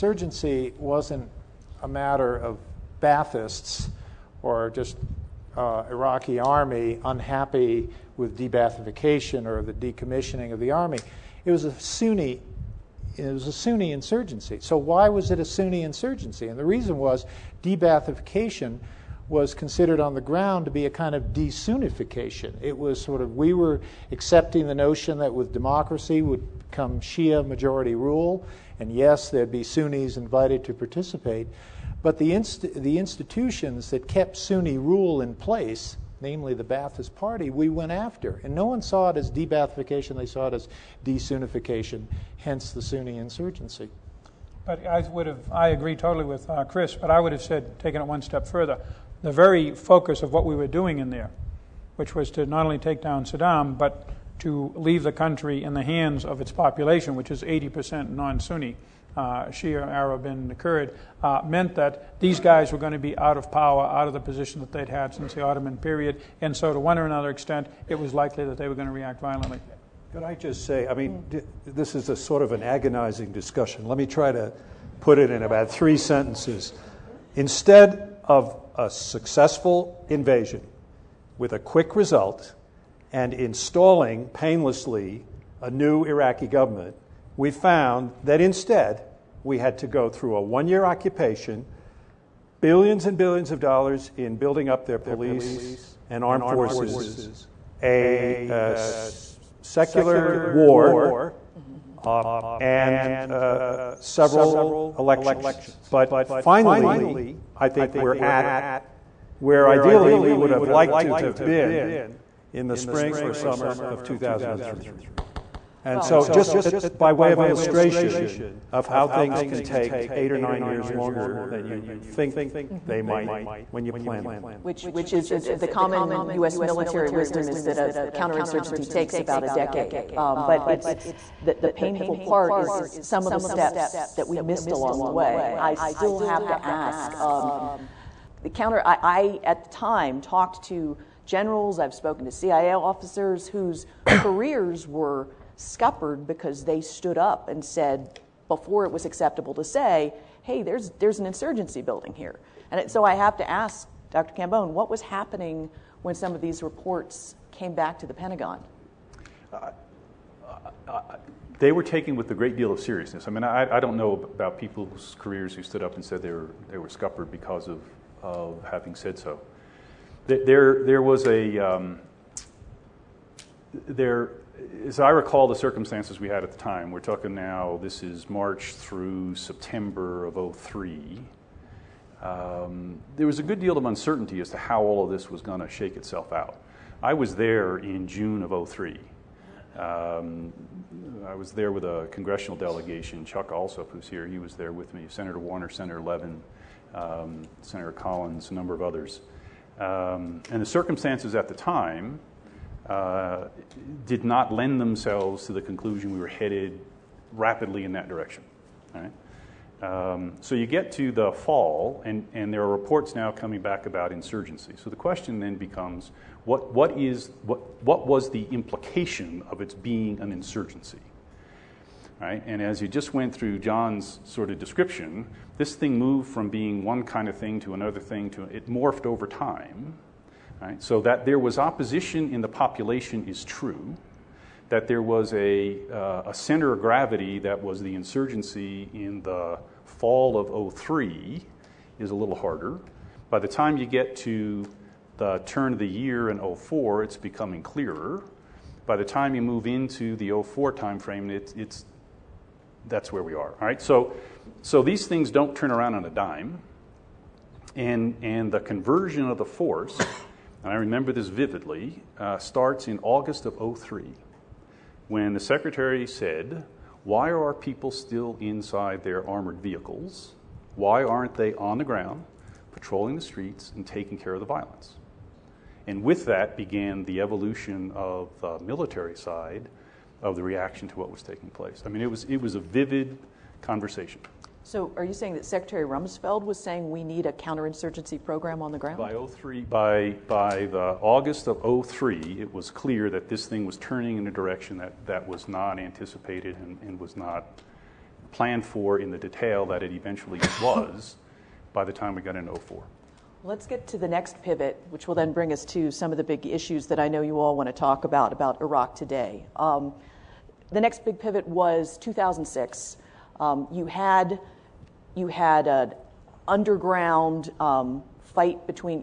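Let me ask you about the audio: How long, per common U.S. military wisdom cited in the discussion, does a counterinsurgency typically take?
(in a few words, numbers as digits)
a decade.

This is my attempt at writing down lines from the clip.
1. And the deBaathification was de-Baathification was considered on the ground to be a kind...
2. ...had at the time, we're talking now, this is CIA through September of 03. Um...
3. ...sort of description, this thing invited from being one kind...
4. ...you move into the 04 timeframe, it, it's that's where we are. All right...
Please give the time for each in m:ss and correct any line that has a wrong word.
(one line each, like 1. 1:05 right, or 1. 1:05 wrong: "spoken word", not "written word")
1. 0:16 wrong: "reason", not "deBaathification"
2. 2:56 wrong: "March", not "CIA"
3. 3:44 wrong: "moved", not "invited"
4. 4:09 right.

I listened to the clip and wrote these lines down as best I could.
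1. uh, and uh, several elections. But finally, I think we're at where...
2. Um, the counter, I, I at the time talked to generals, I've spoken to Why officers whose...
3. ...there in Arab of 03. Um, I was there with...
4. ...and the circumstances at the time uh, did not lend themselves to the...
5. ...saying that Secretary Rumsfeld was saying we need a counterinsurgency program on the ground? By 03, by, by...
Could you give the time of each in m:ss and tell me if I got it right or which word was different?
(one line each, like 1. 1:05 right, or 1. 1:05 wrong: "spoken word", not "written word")
1. 1:42 right
2. 2:17 wrong: "CIA", not "Why"
3. 3:07 wrong: "June", not "Arab"
4. 3:20 right
5. 4:45 right.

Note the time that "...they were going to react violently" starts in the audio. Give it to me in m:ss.
1:08.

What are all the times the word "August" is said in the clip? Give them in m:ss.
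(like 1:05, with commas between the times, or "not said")
4:23, 4:51.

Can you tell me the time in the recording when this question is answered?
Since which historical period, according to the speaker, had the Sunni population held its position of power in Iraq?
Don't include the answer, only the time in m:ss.
1:05.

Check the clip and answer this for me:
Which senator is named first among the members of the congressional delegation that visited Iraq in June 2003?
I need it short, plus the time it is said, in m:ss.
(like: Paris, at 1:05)
Senator Warner, at 3:15.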